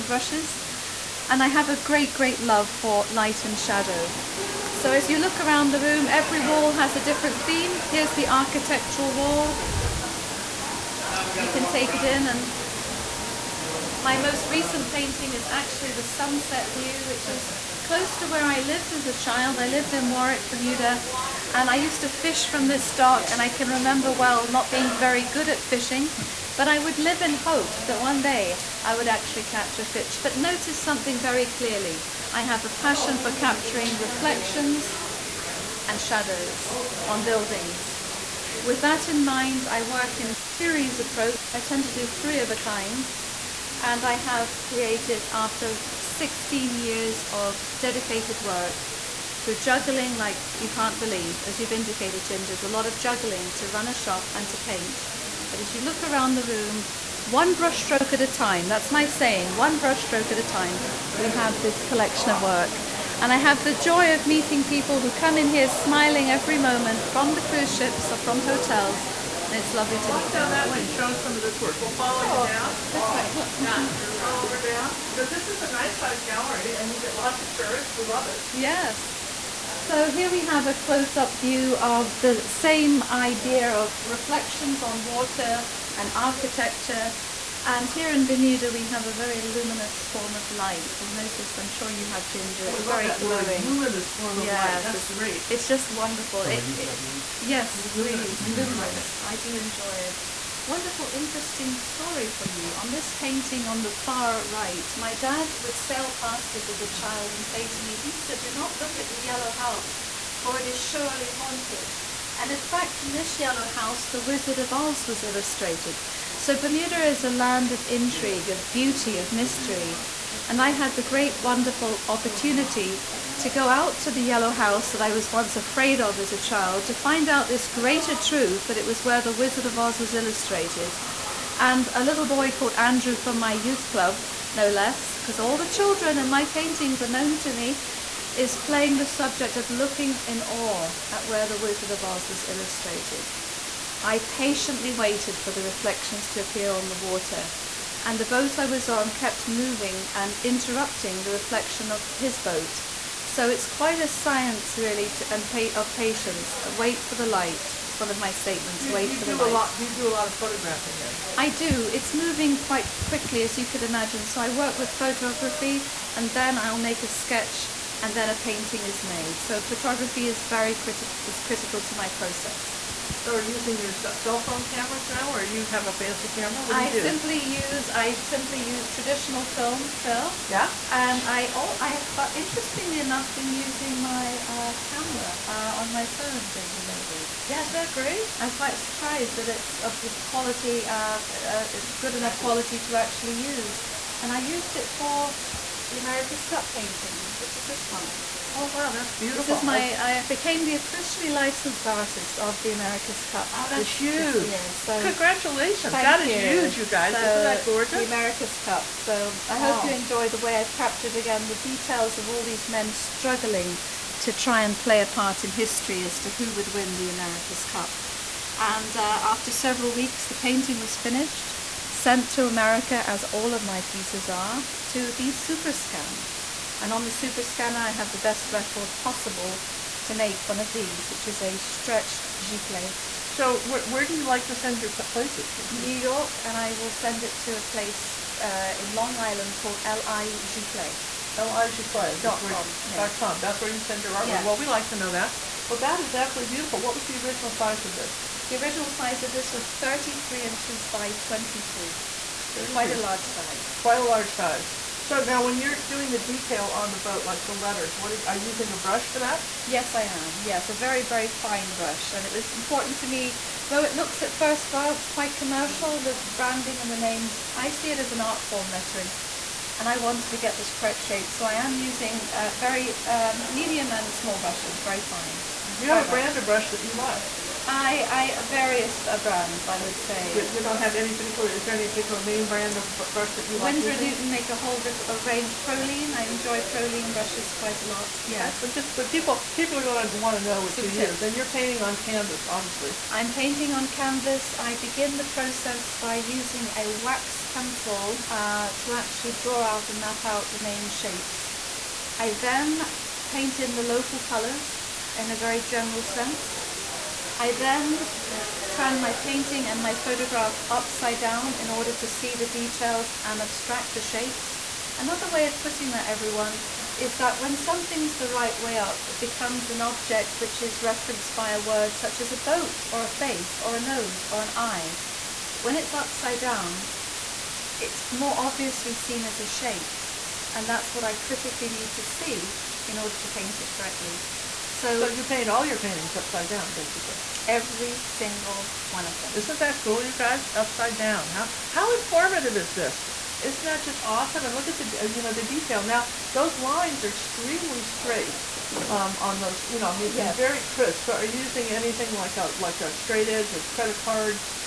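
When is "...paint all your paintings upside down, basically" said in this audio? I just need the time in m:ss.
5:35.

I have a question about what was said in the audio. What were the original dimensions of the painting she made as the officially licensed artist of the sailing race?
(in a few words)
33 inches by 23.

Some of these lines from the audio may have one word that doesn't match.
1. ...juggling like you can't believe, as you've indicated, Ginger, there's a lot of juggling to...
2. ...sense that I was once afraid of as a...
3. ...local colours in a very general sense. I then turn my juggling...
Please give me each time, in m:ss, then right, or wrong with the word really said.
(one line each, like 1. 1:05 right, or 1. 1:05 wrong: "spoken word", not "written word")
1. 0:49 right
2. 2:04 wrong: "house", not "sense"
3. 5:03 wrong: "painting", not "juggling".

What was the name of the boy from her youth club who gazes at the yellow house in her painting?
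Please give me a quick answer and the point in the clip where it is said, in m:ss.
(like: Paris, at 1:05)
Andrew, at 2:12.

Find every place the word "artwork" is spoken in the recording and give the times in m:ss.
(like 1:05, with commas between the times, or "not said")
4:04.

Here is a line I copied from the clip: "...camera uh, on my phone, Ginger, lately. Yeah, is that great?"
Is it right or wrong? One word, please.
right.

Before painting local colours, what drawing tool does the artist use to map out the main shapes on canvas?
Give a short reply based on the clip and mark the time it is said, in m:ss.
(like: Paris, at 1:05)
Wax pencil, at 4:56.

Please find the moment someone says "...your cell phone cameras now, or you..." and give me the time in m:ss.
2:53.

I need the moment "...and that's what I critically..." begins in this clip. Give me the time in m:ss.
5:30.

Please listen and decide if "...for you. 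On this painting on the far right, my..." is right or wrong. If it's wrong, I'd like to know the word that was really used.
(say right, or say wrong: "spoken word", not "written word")
right.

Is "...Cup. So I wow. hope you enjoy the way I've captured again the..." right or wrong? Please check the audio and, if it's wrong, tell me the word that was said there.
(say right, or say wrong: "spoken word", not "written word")
right.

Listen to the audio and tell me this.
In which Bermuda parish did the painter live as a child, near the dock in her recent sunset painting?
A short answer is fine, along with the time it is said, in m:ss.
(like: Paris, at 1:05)
Warwick, at 0:20.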